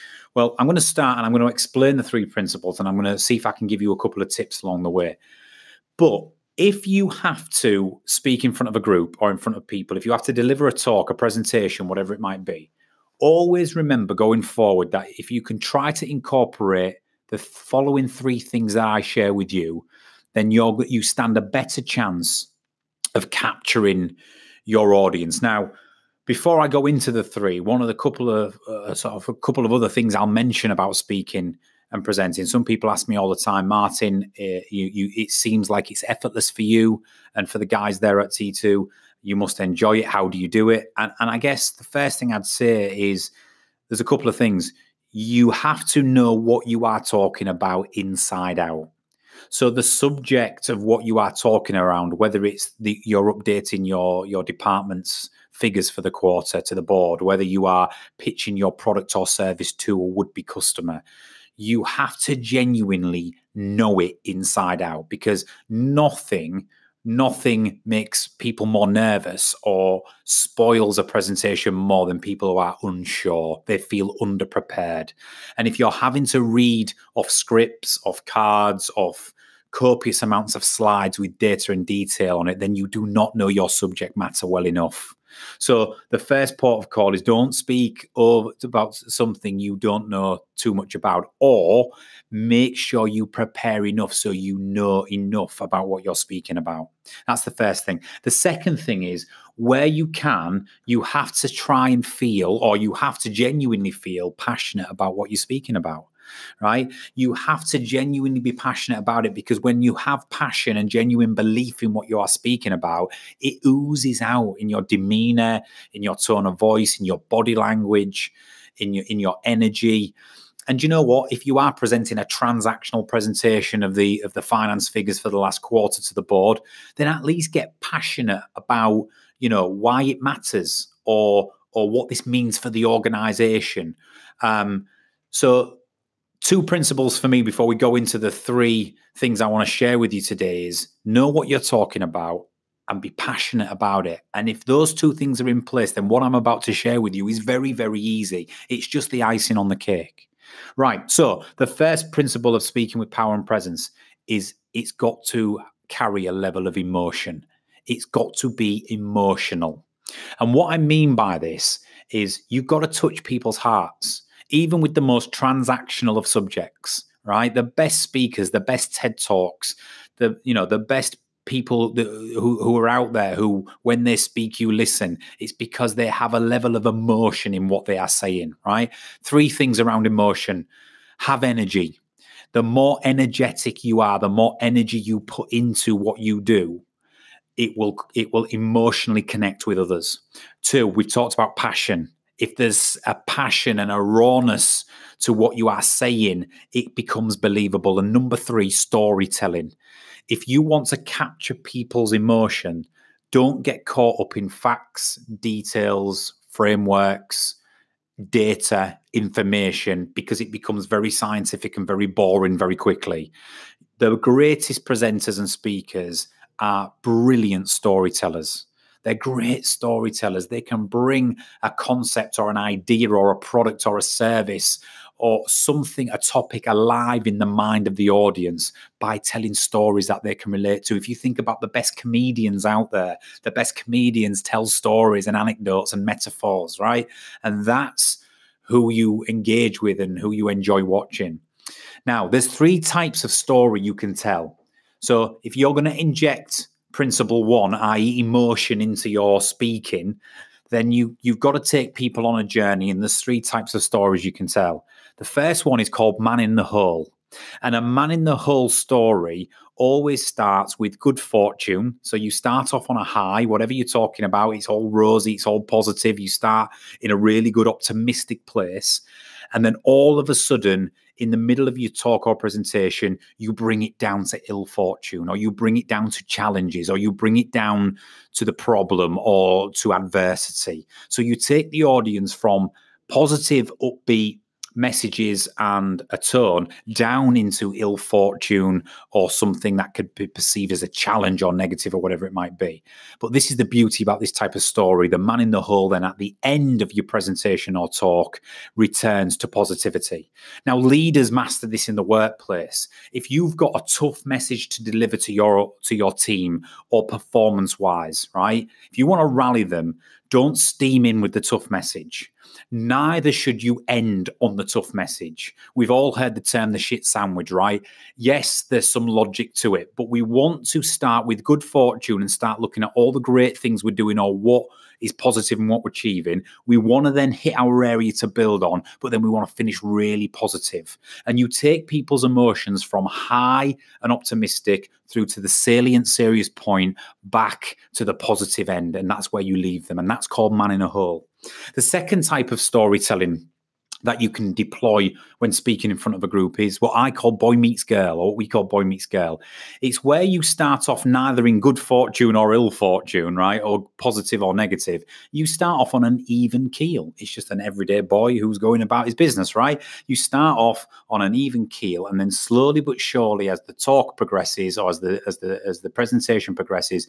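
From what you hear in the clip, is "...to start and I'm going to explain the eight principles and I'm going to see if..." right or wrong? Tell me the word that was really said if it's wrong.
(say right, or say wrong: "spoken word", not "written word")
wrong: "three", not "eight".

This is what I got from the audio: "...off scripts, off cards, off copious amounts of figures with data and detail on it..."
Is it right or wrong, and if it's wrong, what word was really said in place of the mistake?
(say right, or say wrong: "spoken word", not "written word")
wrong: "slides", not "figures".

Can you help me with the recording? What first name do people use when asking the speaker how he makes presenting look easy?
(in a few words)
Martin.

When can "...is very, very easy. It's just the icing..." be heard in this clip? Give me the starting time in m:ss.
2:27.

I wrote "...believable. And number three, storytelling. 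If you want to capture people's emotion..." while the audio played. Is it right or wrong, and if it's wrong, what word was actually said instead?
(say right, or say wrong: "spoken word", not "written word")
right.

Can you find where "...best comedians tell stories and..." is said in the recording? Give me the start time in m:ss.
3:53.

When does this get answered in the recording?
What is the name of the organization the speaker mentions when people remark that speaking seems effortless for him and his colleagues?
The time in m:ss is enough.
0:38.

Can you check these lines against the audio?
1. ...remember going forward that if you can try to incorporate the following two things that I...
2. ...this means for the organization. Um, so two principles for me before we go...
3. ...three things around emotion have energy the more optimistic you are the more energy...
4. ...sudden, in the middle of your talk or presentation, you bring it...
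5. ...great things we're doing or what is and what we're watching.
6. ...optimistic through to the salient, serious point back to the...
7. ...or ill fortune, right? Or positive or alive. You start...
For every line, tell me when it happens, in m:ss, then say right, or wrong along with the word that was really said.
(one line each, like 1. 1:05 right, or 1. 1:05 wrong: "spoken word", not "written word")
1. 0:13 wrong: "three", not "two"
2. 2:12 right
3. 2:59 wrong: "energetic", not "optimistic"
4. 4:30 right
5. 5:23 wrong: "achieving", not "watching"
6. 5:34 right
7. 5:52 wrong: "negative", not "alive".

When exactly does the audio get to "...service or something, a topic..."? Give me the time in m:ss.
3:44.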